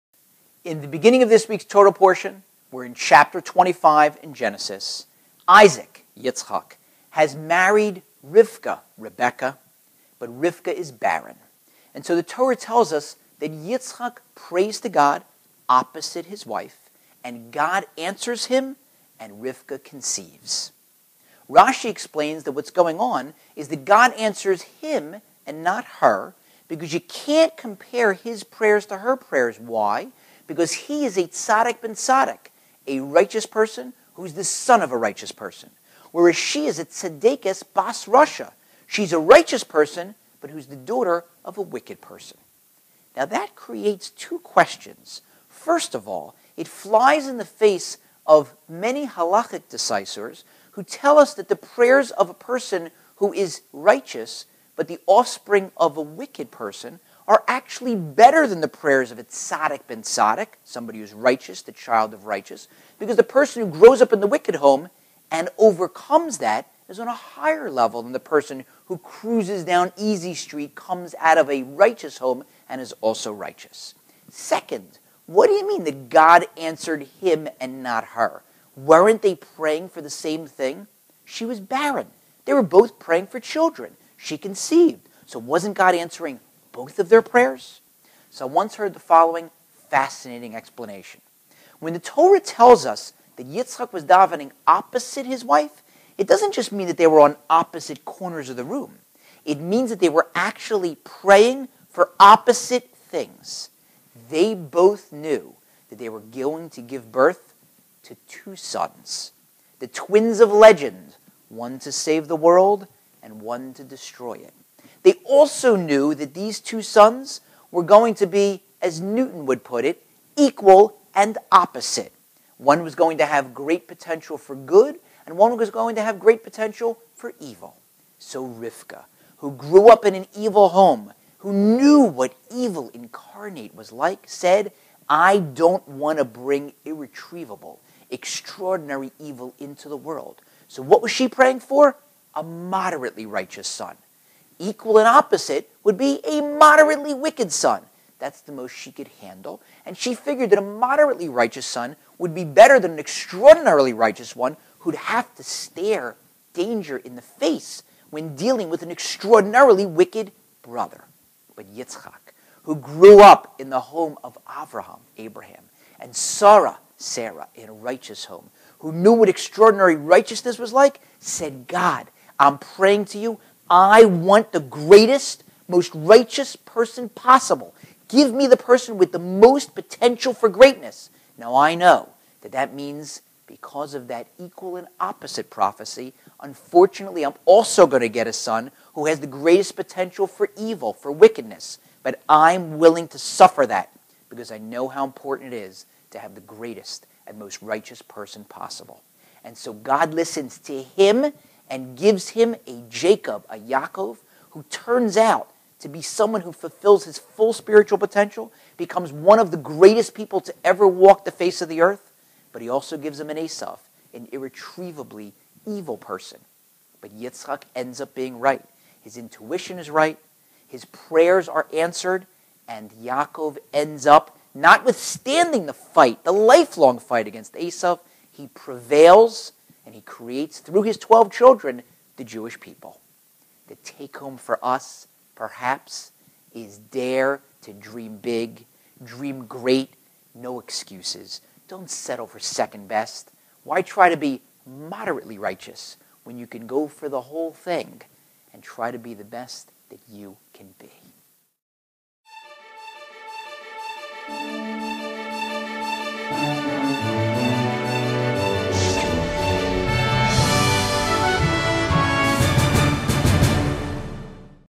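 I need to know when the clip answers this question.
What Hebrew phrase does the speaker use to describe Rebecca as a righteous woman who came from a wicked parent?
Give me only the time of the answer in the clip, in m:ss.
0:36.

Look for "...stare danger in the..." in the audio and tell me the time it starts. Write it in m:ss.
2:35.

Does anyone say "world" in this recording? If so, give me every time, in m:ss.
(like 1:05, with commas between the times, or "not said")
1:52, 2:19.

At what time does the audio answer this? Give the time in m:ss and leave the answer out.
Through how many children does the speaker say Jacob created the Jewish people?
3:50.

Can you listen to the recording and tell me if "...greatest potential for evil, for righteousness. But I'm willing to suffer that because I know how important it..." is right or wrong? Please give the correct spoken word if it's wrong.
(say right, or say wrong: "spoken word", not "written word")
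wrong: "wickedness", not "righteousness".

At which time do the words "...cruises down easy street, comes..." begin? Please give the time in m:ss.
1:08.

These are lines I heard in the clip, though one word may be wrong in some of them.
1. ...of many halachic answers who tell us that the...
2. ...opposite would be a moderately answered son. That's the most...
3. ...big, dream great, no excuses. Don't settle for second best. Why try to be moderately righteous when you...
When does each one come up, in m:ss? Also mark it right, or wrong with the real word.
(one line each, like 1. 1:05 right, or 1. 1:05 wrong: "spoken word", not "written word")
1. 0:48 wrong: "decisors", not "answers"
2. 2:25 wrong: "wicked", not "answered"
3. 3:58 right.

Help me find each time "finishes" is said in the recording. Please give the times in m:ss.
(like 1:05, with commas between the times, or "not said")
not said.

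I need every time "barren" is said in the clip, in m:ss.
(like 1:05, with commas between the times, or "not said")
0:10, 1:21.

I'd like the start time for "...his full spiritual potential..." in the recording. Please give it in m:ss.
3:27.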